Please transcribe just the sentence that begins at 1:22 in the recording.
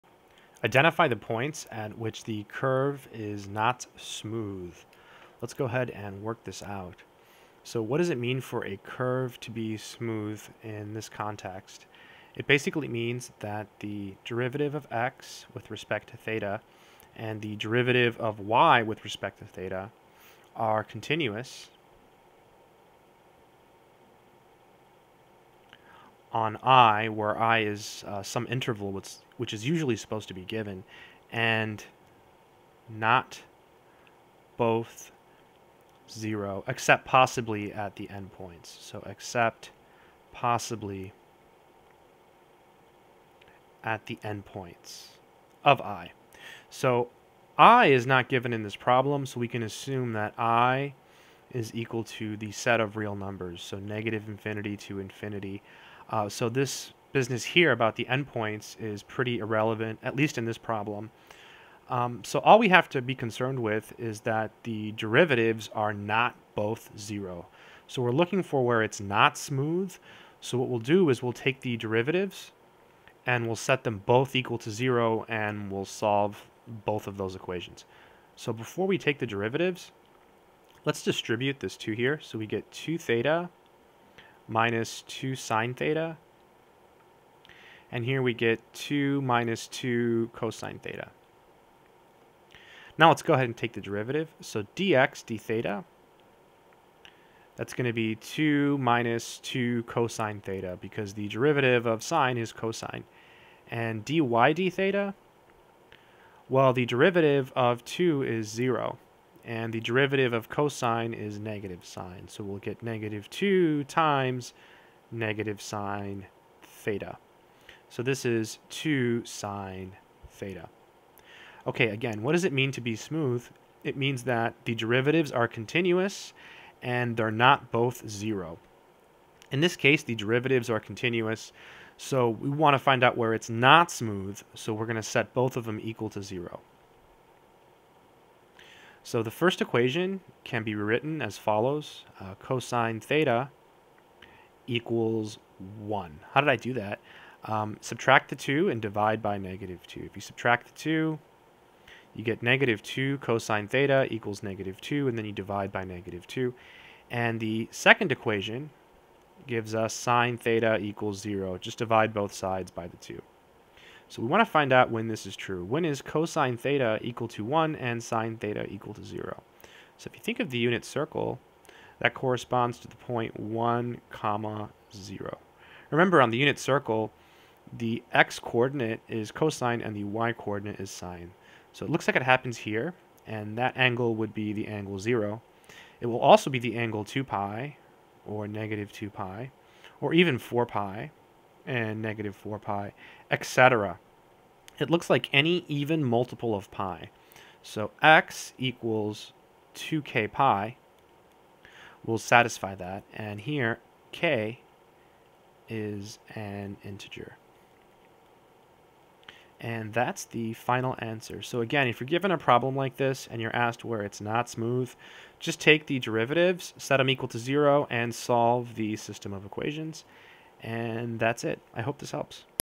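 So we get 2 theta minus 2 sine theta.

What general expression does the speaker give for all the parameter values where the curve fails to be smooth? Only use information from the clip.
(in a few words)
2kπ.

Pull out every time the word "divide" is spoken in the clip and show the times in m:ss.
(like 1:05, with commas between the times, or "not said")
2:28, 2:35, 2:41.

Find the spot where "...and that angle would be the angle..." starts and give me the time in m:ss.
3:03.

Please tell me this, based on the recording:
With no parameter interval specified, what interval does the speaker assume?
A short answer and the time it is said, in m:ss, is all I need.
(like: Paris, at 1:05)
the set of real numbers, at 0:52.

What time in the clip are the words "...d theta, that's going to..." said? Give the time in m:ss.
1:35.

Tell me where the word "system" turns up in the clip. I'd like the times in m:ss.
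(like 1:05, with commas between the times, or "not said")
3:38.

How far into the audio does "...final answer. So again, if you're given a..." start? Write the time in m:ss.
3:30.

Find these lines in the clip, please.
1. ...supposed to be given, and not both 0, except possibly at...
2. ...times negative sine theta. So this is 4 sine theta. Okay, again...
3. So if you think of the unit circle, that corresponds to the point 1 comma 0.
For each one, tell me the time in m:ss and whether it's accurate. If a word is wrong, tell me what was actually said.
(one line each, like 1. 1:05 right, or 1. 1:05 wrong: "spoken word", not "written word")
1. 0:29 right
2. 1:53 wrong: "2", not "4"
3. 2:49 right.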